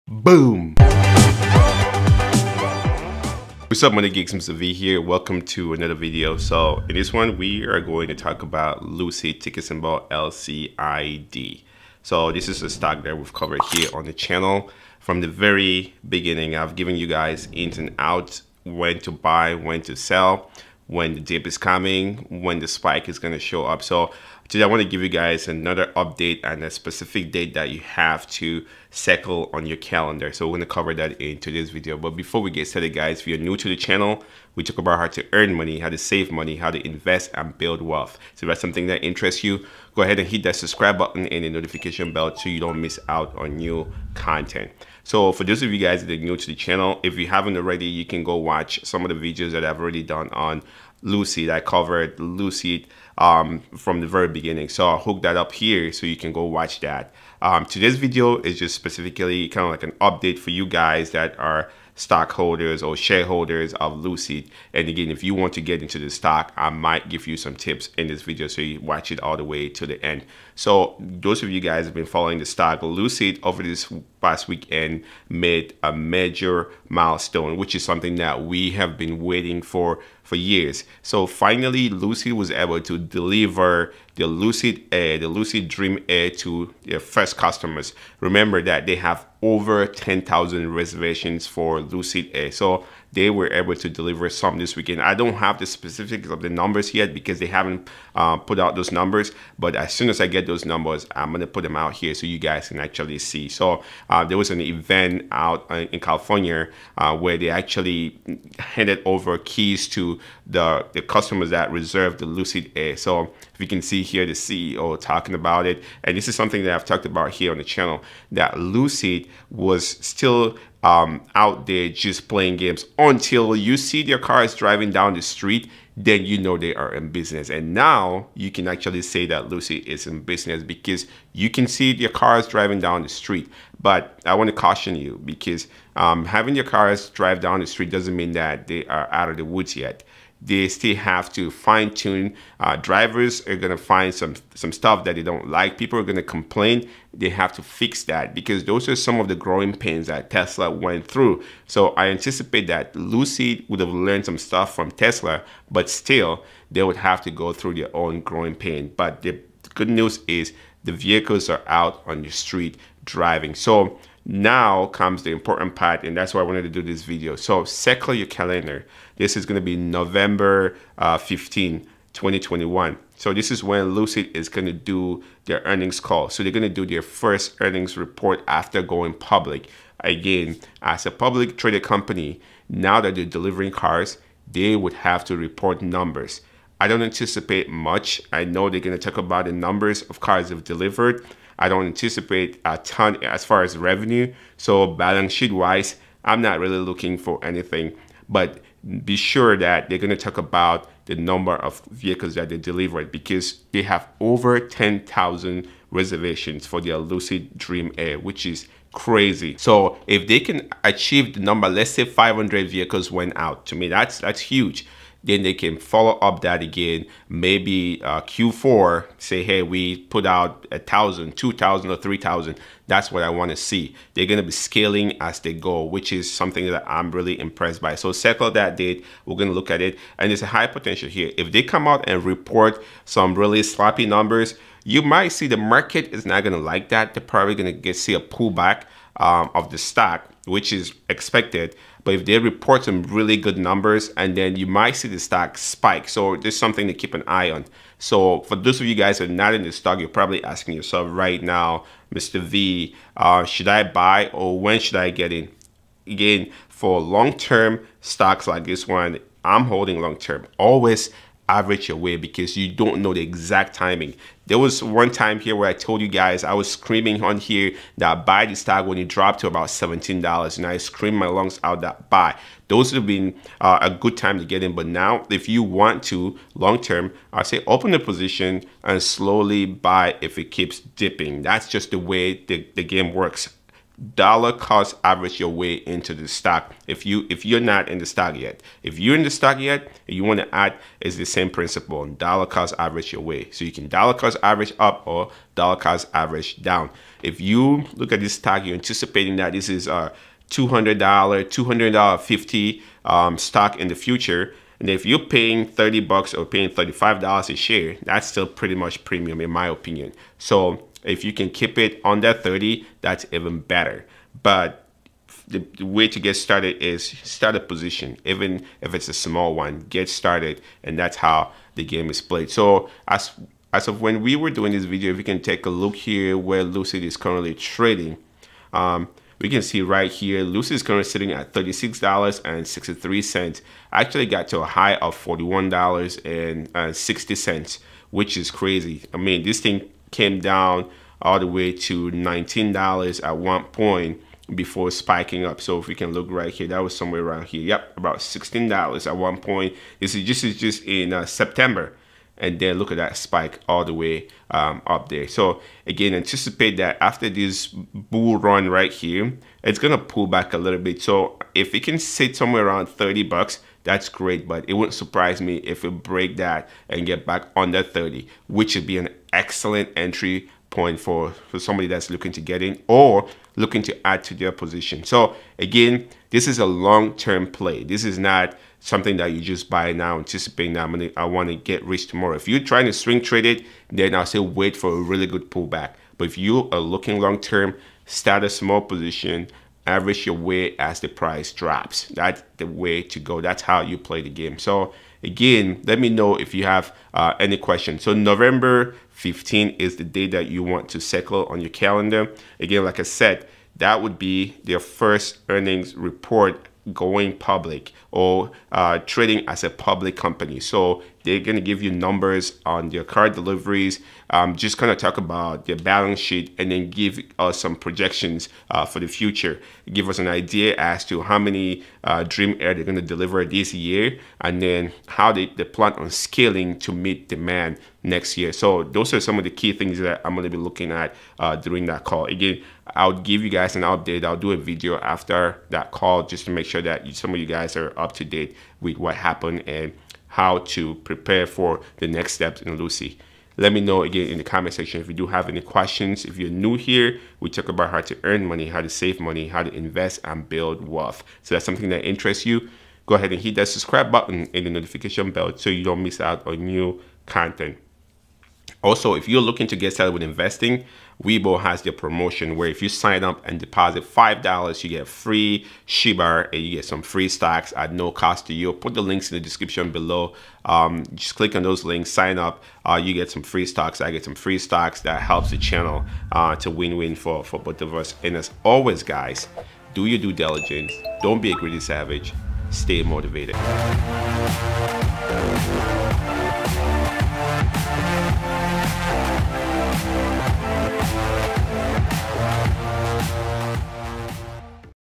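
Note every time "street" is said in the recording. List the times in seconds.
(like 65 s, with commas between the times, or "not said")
125 s, 133 s, 137 s, 162 s.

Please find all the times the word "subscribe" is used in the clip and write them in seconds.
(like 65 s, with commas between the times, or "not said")
40 s, 453 s.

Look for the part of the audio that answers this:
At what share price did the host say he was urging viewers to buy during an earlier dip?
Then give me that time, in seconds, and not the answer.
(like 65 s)
269 s.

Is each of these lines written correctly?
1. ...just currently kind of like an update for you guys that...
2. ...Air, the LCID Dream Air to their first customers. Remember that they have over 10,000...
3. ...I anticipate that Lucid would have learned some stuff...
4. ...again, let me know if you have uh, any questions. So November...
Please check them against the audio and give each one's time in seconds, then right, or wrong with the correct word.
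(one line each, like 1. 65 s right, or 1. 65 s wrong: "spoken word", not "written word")
1. 58 s wrong: "specifically", not "currently"
2. 84 s wrong: "Lucid", not "LCID"
3. 151 s right
4. 395 s right.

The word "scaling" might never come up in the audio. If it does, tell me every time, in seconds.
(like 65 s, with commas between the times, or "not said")
224 s, 426 s.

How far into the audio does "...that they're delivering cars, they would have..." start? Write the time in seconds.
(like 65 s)
183 s.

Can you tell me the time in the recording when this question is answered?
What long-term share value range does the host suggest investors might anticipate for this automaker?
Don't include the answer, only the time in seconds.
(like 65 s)
300 s.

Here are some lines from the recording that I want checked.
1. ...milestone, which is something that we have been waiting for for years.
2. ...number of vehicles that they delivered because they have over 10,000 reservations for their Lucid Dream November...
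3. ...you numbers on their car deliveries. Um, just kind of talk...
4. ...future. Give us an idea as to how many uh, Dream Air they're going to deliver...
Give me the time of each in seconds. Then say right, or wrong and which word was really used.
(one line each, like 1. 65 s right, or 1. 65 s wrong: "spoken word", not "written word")
1. 76 s right
2. 201 s wrong: "Air", not "November"
3. 411 s right
4. 419 s right.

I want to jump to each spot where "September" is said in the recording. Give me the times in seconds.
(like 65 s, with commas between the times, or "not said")
351 s.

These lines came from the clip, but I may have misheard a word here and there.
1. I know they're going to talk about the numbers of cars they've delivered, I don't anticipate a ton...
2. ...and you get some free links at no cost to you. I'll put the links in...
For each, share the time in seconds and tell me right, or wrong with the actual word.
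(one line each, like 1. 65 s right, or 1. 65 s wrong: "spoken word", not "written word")
1. 188 s right
2. 466 s wrong: "stocks", not "links".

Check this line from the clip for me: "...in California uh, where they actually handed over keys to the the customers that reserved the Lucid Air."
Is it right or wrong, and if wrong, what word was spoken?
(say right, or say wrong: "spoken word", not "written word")
right.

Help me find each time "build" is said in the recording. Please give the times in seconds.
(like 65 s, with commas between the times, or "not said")
37 s, 450 s.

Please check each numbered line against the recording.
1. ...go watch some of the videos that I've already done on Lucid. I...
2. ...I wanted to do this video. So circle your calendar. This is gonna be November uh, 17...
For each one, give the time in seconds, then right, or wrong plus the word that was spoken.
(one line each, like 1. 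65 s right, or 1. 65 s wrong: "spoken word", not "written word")
1. 48 s right
2. 166 s wrong: "15", not "17".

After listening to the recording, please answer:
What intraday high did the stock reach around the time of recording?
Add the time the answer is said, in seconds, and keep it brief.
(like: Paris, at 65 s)
$41.60, at 335 s.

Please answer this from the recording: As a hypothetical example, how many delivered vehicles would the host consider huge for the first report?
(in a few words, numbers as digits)
500.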